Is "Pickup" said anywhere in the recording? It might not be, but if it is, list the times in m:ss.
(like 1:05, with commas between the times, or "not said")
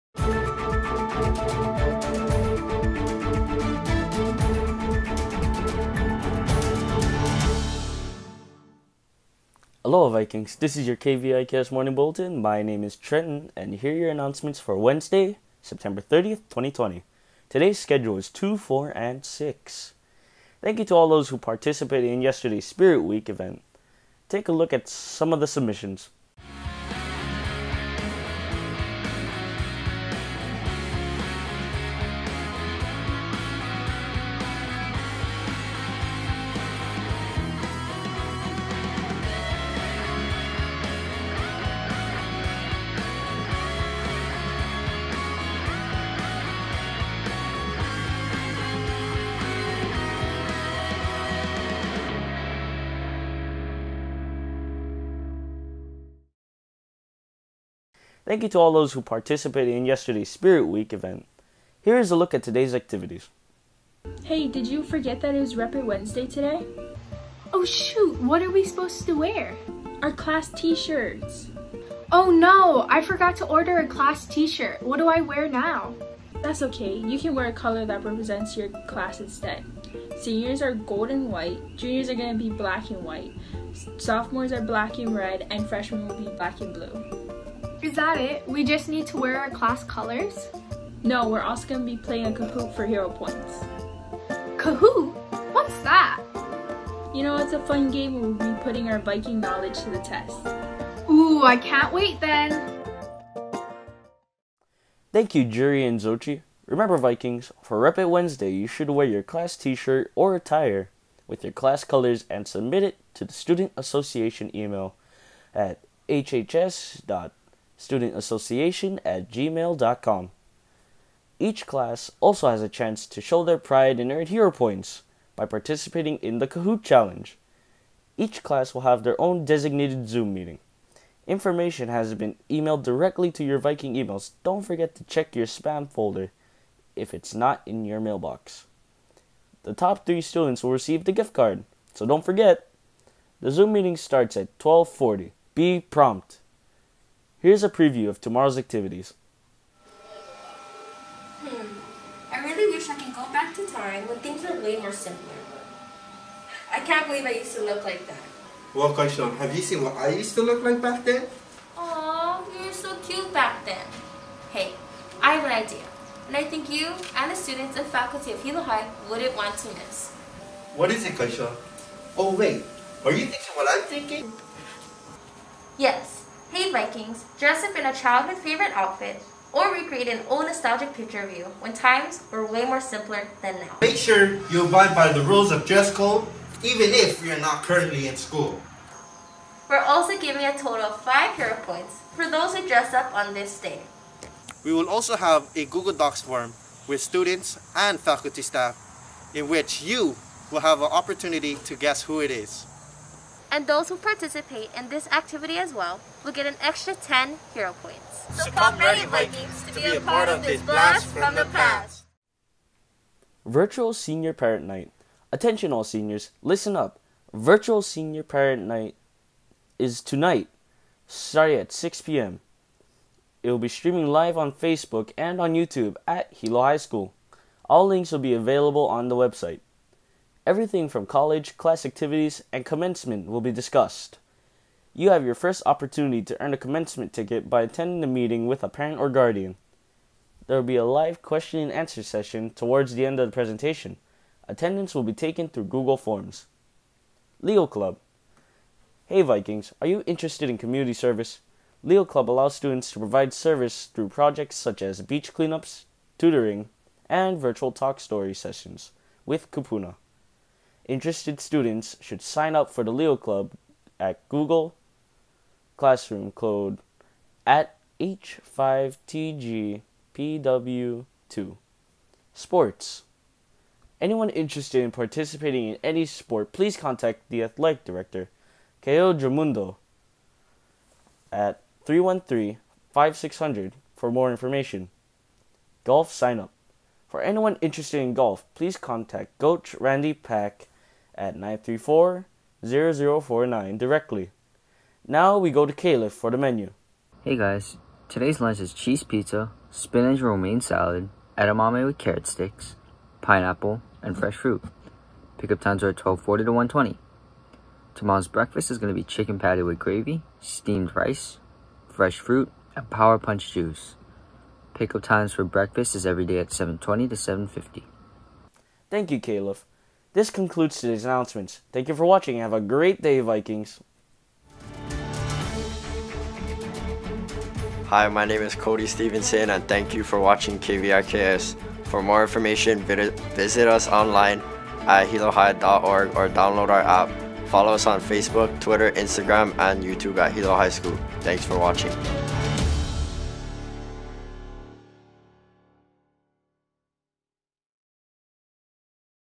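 5:05, 5:14.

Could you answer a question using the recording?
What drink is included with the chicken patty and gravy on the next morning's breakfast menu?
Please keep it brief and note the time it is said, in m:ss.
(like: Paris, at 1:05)
Power punch juice, at 5:12.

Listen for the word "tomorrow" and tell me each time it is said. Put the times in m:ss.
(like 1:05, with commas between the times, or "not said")
2:28, 5:07.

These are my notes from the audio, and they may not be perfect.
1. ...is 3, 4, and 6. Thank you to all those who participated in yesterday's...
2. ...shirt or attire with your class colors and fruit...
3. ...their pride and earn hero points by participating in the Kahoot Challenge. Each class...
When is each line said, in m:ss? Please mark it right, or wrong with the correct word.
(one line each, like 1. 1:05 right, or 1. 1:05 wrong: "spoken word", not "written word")
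1. 0:18 wrong: "2", not "3"
2. 1:49 wrong: "submit", not "fruit"
3. 2:03 right.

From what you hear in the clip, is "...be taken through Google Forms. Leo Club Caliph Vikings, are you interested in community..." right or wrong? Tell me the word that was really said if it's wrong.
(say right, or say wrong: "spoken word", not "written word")
wrong: "Hey", not "Caliph".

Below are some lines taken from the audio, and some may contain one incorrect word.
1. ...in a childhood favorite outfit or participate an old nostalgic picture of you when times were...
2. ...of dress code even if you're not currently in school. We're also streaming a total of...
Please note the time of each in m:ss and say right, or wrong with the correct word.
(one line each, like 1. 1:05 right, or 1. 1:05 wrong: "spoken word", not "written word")
1. 2:57 wrong: "recreate", not "participate"
2. 3:05 wrong: "giving", not "streaming".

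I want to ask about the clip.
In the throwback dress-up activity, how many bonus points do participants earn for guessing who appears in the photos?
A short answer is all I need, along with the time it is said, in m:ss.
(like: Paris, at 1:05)
10, at 3:26.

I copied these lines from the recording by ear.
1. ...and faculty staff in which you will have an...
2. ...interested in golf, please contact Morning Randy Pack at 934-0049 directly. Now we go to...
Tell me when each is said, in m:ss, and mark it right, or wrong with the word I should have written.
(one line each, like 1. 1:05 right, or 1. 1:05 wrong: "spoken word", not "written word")
1. 3:17 right
2. 4:47 wrong: "Coach", not "Morning".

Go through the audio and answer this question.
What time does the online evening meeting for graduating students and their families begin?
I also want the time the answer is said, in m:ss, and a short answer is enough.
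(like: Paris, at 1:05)
6 p.m., at 3:41.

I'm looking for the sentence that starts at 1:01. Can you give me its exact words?
Here is a look at today's activities.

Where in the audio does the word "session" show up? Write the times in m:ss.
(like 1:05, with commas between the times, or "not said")
4:02, 4:18.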